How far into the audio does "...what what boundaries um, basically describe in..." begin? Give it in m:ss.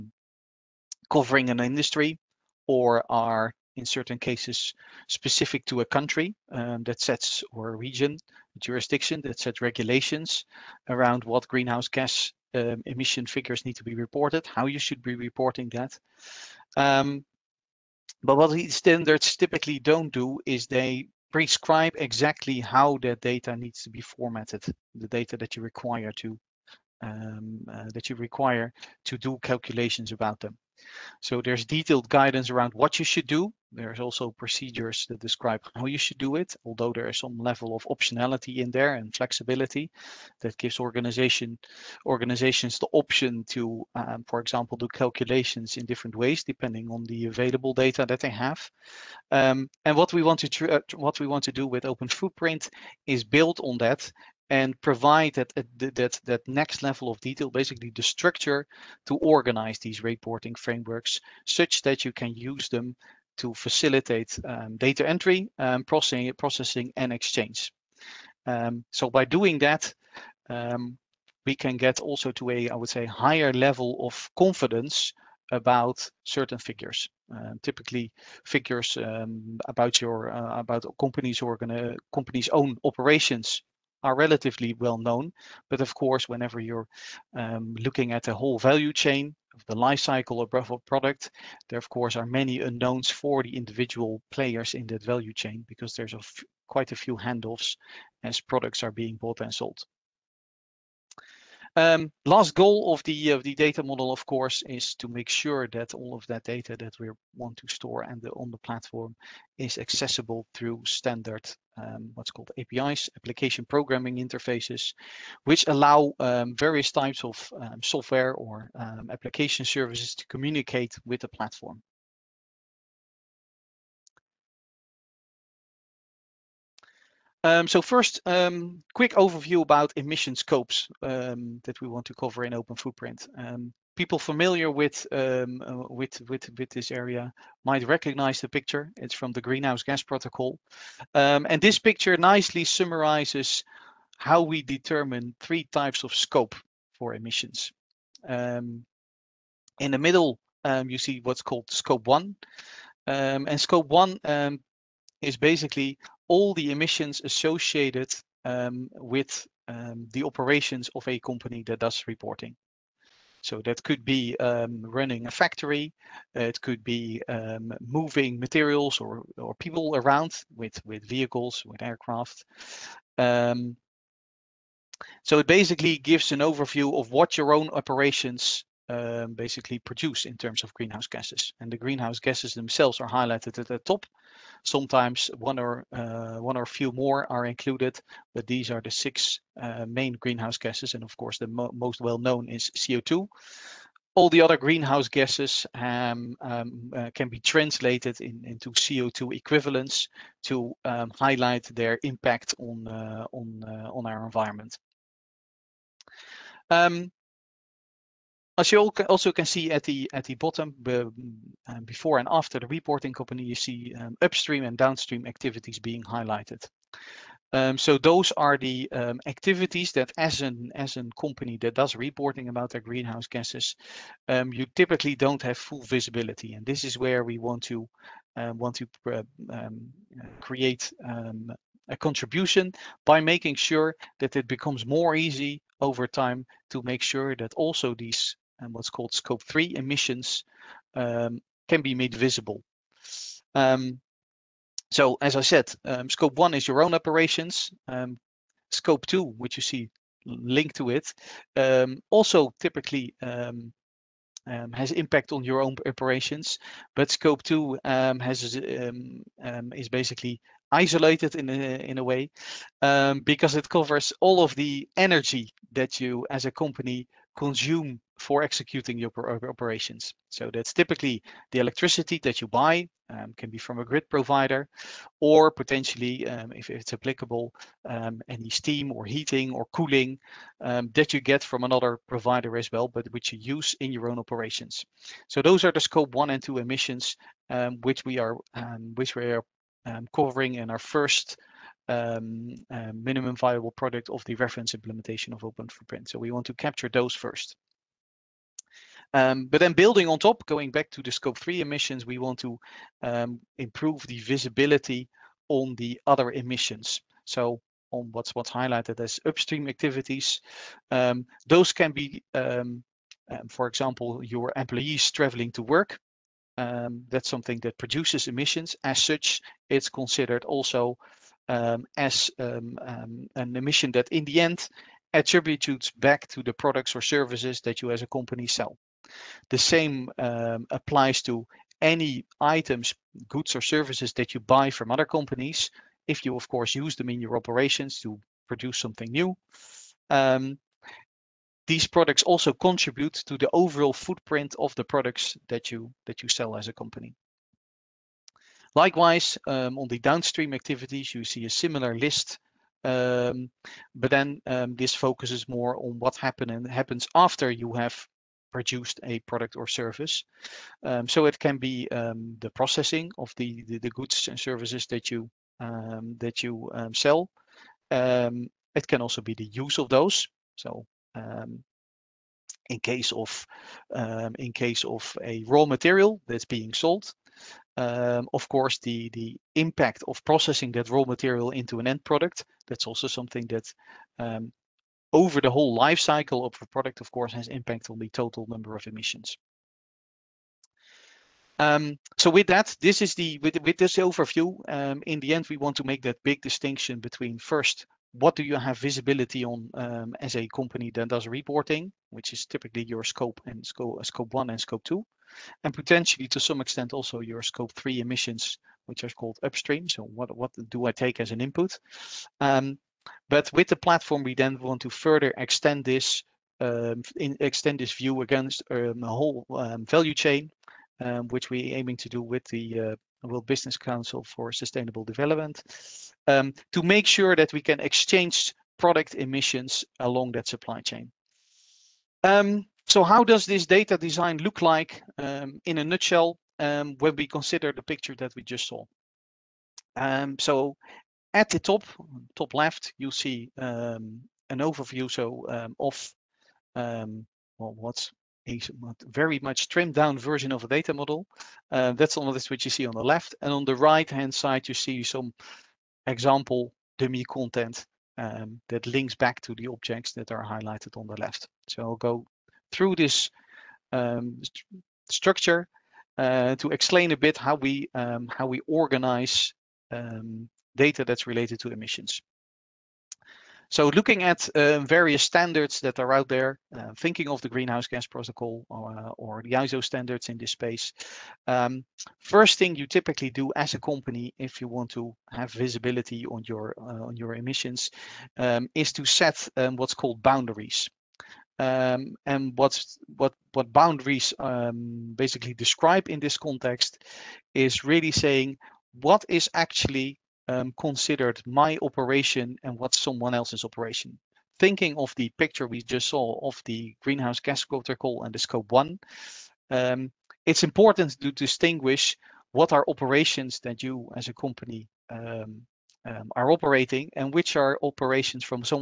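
8:13.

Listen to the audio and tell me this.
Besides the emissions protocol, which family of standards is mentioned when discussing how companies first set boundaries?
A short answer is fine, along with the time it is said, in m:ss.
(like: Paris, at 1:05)
ISO standards, at 7:59.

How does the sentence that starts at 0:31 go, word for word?
So there's detailed guidance around what you should do.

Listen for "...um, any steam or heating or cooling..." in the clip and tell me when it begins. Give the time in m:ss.
4:37.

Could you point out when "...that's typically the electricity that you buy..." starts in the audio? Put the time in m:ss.
4:30.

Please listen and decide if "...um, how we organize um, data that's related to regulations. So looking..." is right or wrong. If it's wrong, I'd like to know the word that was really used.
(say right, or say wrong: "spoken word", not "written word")
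wrong: "emissions", not "regulations".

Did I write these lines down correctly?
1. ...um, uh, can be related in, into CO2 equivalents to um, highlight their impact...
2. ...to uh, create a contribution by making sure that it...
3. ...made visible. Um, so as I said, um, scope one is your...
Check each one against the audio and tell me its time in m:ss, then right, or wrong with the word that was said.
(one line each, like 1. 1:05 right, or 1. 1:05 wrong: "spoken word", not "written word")
1. 3:16 wrong: "translated", not "related"
2. 3:48 right
3. 4:01 right.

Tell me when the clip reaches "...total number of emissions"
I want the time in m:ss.
6:28.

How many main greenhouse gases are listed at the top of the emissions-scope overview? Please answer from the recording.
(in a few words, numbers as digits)
6.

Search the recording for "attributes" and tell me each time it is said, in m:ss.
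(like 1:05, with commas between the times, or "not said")
5:25.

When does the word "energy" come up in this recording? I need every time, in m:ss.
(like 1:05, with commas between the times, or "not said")
4:24.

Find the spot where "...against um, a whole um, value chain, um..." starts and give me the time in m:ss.
6:58.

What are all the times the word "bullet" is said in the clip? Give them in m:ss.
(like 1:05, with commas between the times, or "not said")
not said.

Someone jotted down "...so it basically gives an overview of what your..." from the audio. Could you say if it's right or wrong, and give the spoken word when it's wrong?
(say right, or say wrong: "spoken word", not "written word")
right.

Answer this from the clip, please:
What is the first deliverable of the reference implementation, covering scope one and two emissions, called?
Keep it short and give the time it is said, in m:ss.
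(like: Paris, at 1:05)
minimum viable product, at 4:52.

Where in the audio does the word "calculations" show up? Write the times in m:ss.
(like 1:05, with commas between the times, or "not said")
0:29, 0:44.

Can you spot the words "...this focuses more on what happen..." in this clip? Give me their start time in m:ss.
5:54.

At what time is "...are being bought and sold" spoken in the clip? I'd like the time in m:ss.
1:38.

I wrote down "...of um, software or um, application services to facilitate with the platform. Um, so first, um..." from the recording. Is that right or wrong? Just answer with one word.
wrong.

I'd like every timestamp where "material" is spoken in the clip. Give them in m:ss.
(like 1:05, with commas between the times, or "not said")
2:48, 6:15, 6:21.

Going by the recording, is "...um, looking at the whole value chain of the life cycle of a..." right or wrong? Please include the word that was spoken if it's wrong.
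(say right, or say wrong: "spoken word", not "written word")
right.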